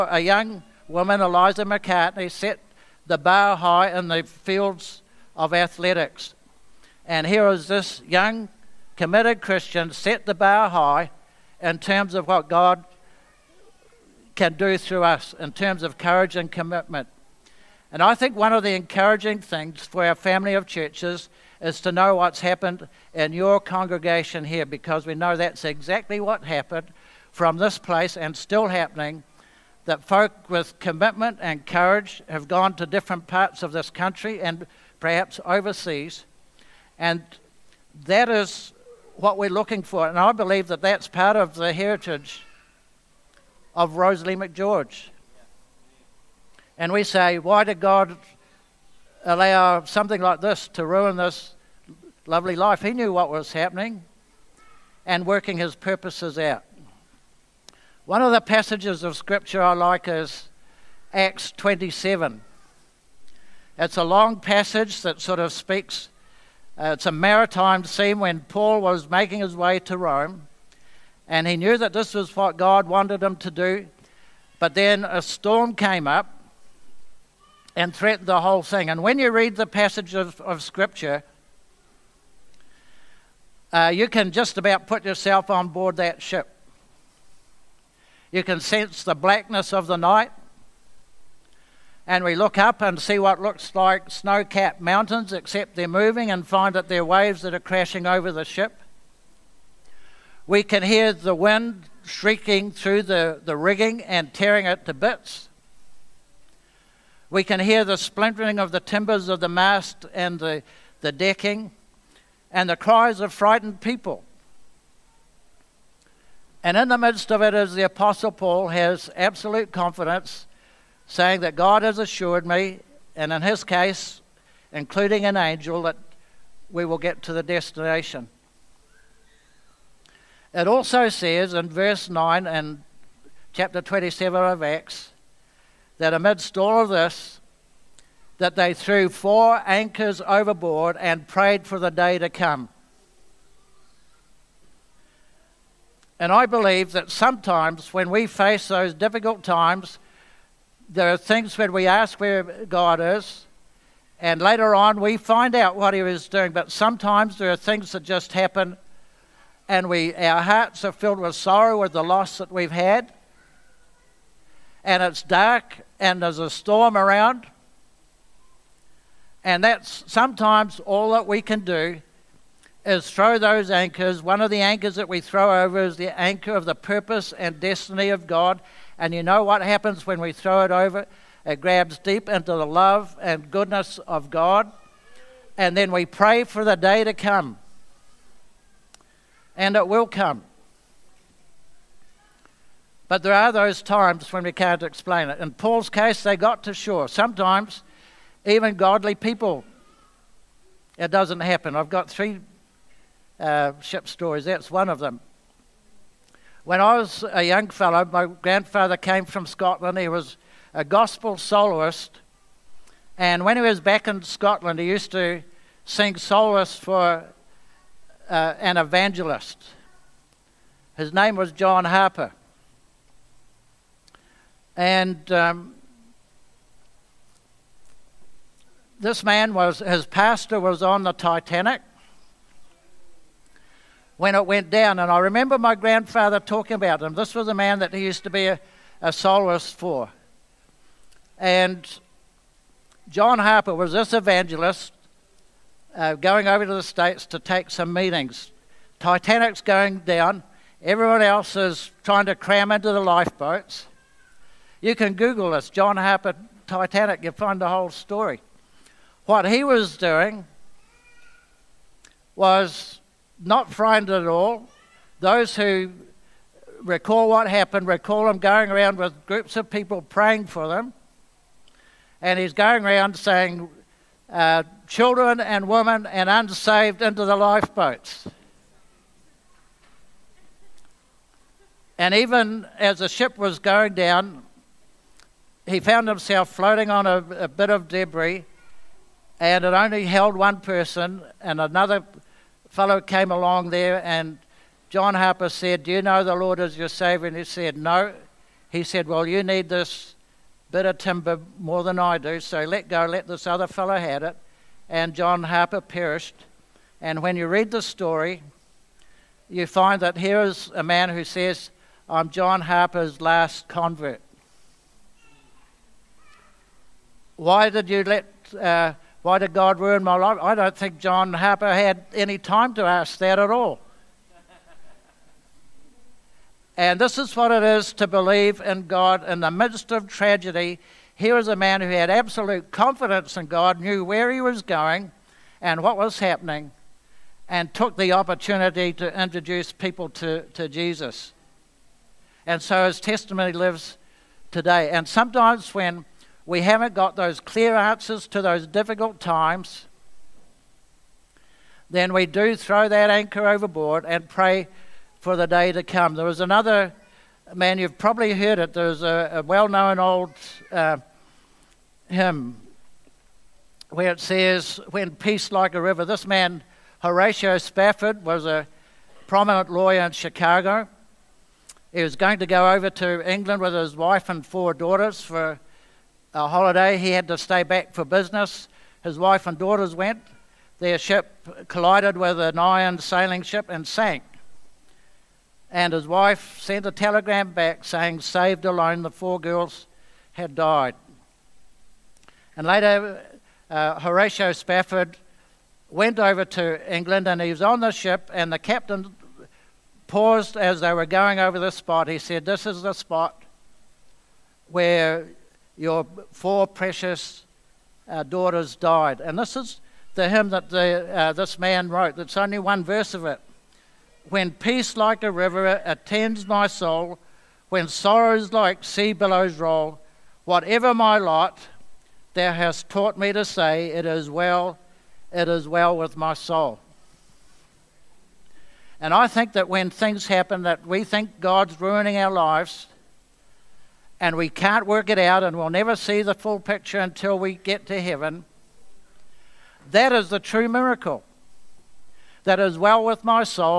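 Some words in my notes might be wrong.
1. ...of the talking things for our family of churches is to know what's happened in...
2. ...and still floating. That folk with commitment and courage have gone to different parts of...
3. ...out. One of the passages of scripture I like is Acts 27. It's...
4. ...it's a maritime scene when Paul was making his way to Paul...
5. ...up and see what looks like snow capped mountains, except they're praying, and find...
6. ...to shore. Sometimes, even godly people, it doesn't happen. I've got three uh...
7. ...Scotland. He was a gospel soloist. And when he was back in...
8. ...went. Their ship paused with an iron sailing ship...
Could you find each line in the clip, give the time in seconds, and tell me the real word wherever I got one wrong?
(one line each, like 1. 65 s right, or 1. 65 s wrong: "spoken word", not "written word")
1. 18 s wrong: "encouraging", not "talking"
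2. 28 s wrong: "happening", not "floating"
3. 56 s right
4. 66 s wrong: "Rome", not "Paul"
5. 92 s wrong: "moving", not "praying"
6. 196 s right
7. 209 s right
8. 379 s wrong: "collided", not "paused".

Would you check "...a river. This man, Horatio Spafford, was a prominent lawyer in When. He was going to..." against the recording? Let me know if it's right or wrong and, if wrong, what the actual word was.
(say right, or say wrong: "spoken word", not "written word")
wrong: "Chicago", not "When".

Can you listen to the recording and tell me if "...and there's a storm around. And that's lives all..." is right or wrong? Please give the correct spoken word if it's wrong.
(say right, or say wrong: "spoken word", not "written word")
wrong: "sometimes", not "lives".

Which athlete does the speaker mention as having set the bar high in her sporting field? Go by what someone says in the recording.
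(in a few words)
Eliza McCartney.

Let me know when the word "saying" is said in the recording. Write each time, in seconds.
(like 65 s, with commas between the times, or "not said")
121 s, 273 s, 387 s.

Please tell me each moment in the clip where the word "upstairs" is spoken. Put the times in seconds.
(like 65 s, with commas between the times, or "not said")
not said.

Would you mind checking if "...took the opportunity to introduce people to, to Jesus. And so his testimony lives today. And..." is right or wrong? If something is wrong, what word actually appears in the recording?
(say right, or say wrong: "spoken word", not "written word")
right.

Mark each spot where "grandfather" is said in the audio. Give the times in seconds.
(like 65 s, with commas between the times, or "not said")
208 s, 235 s.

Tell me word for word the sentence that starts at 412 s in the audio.
That's only one verse of it.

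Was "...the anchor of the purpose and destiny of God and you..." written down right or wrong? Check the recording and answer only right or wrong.
right.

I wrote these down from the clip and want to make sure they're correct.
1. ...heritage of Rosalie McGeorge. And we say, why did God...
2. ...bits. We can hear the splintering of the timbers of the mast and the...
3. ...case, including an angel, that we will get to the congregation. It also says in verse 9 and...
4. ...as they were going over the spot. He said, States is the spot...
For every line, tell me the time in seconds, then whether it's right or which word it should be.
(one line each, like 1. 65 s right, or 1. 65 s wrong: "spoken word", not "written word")
1. 41 s right
2. 104 s right
3. 123 s wrong: "destination", not "congregation"
4. 400 s wrong: "This", not "States".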